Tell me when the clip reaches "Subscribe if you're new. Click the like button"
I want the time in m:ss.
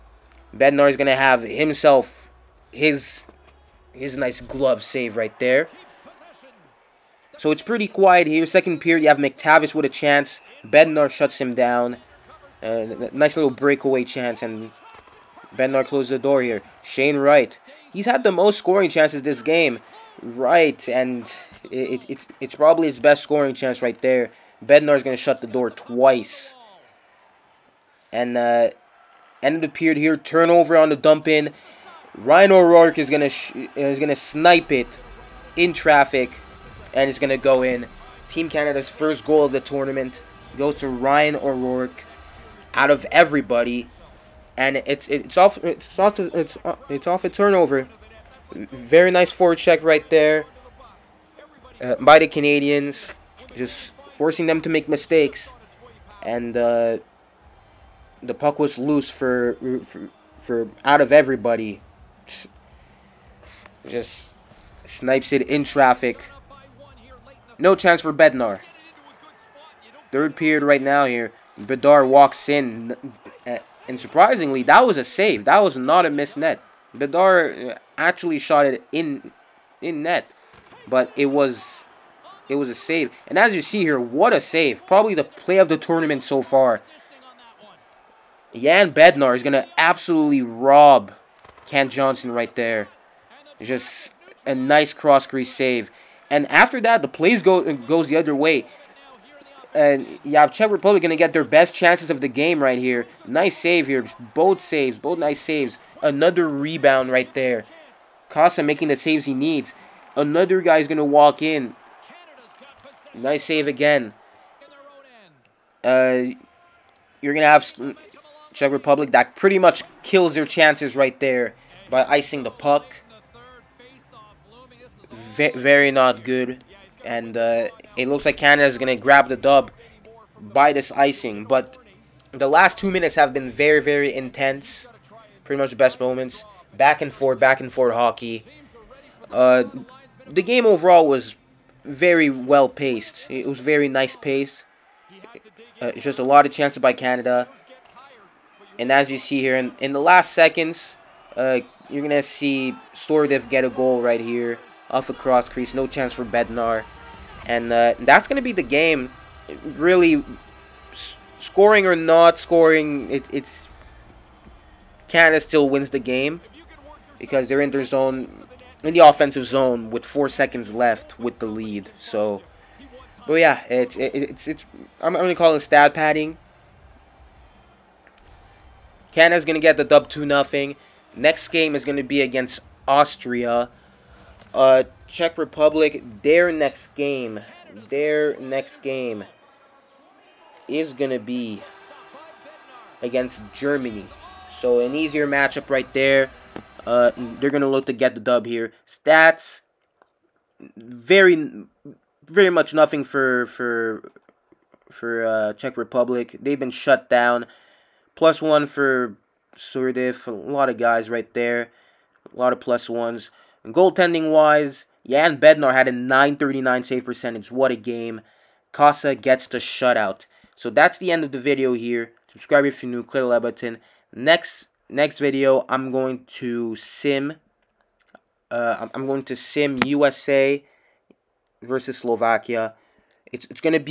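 3:42.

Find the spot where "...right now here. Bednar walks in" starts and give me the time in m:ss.
1:10.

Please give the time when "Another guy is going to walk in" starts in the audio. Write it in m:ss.
1:50.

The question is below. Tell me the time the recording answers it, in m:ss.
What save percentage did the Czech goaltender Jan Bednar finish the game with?
3:35.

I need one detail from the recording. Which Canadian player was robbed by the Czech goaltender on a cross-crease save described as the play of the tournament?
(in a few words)
Cam Johnson.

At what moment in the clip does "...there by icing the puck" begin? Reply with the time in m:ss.
2:01.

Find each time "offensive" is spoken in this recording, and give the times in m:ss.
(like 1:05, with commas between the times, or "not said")
2:49.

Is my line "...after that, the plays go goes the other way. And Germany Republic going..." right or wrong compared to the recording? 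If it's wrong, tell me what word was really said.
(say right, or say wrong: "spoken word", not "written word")
wrong: "Czech", not "Germany".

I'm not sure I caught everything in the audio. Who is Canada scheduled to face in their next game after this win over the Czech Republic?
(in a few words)
Austria.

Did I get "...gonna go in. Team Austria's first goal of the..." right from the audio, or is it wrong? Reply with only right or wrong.
wrong.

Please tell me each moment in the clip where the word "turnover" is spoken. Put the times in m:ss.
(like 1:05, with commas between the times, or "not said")
0:30, 0:47.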